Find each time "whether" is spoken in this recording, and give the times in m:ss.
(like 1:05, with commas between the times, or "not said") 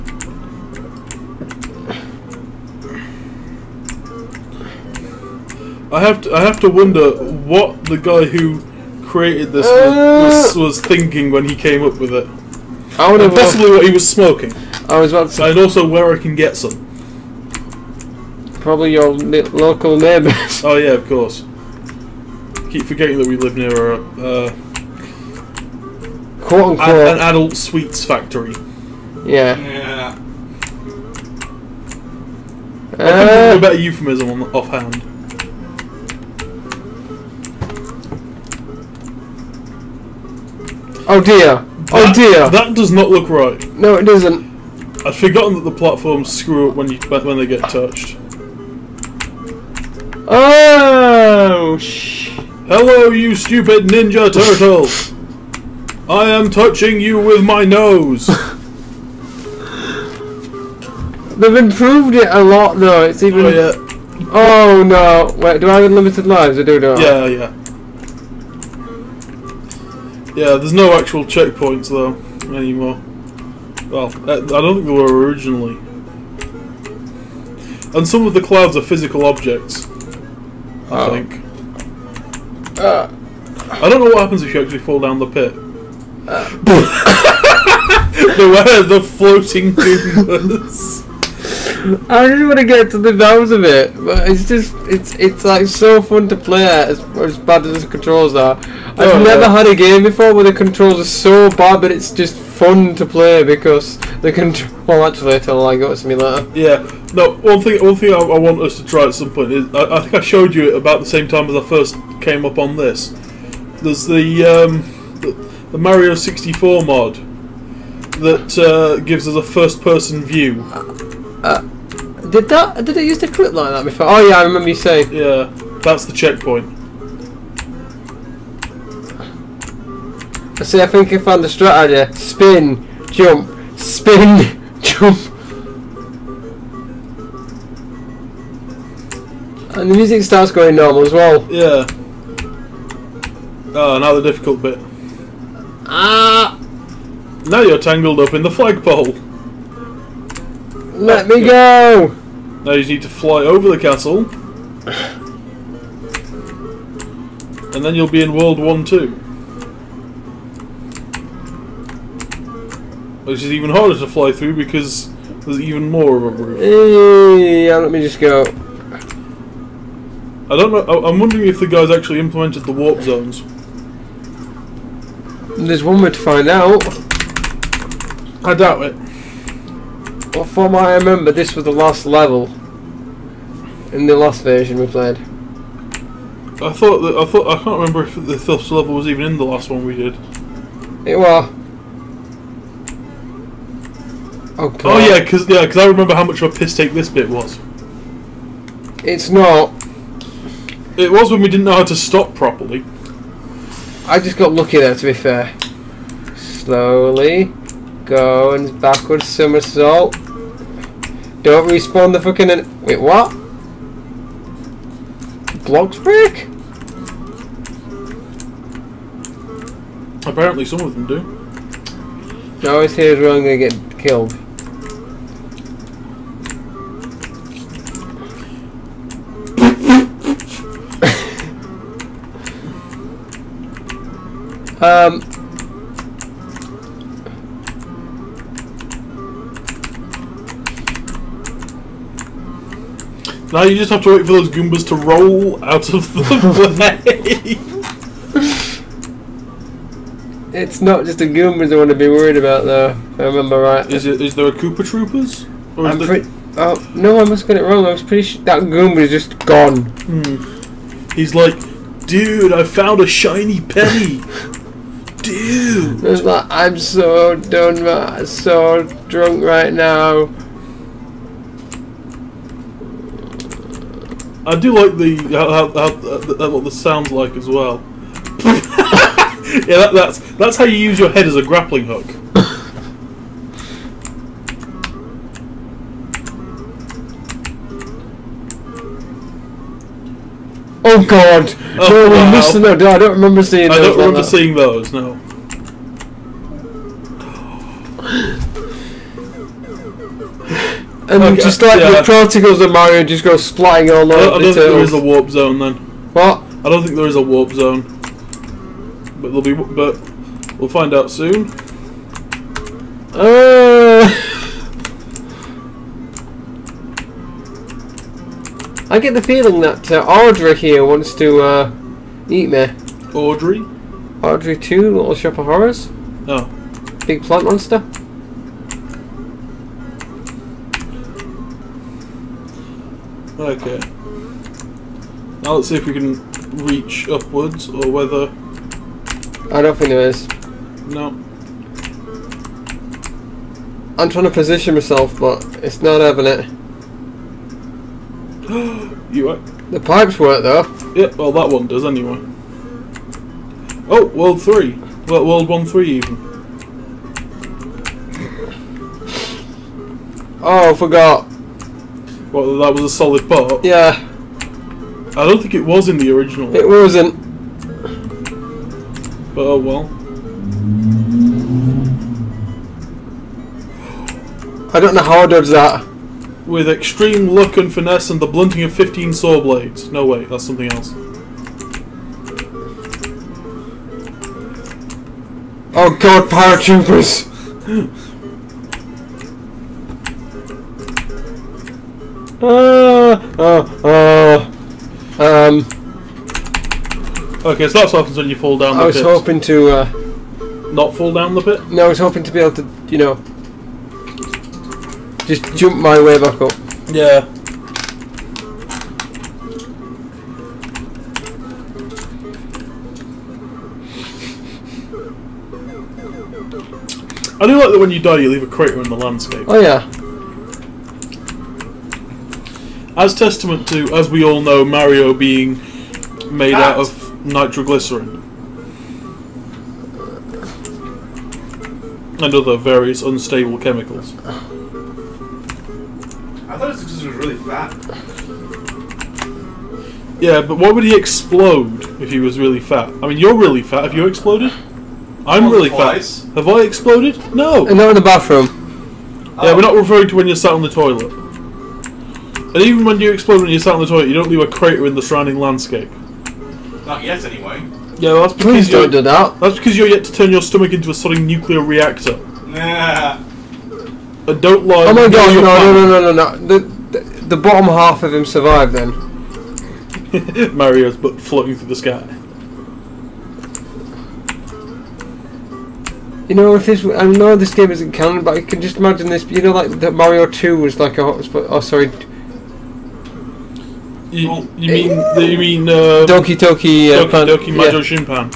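5:37.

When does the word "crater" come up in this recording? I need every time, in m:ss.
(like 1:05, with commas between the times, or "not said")
6:58, 7:34.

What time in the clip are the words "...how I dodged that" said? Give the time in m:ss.
6:15.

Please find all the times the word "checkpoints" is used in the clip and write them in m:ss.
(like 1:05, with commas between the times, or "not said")
1:11, 2:06.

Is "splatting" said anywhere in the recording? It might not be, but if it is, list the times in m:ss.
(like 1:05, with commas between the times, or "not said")
5:03.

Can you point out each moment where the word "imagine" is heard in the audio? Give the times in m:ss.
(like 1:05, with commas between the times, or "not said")
7:58.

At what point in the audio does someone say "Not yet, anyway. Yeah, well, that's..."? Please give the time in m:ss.
7:36.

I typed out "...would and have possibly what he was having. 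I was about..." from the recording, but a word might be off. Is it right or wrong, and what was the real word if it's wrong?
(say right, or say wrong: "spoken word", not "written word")
wrong: "smoking", not "having".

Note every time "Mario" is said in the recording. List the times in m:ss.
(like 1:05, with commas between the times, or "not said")
1:55, 5:02, 7:04, 7:50, 7:59.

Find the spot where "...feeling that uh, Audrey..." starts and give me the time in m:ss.
5:19.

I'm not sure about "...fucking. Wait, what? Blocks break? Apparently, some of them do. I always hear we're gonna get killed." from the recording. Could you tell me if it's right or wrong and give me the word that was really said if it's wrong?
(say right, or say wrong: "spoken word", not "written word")
right.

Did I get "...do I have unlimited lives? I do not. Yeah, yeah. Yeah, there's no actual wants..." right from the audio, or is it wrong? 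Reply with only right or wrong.
wrong.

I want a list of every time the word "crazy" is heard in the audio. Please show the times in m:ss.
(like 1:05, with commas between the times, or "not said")
not said.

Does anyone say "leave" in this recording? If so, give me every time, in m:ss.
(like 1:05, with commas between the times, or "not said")
6:58, 7:34.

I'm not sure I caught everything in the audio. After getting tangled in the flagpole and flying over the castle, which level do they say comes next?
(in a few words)
World 1-2.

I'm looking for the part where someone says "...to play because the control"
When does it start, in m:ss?
1:42.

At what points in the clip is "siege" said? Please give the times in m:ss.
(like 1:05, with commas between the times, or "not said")
not said.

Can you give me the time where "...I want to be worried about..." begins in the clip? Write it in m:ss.
4:11.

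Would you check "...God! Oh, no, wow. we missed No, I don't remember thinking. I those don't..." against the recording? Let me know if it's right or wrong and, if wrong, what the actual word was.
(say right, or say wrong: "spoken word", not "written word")
wrong: "seeing", not "thinking".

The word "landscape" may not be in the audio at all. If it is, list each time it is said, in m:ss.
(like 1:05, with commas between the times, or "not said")
6:58, 7:35.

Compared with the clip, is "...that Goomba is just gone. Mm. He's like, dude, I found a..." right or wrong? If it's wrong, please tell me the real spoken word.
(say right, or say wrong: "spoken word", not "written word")
right.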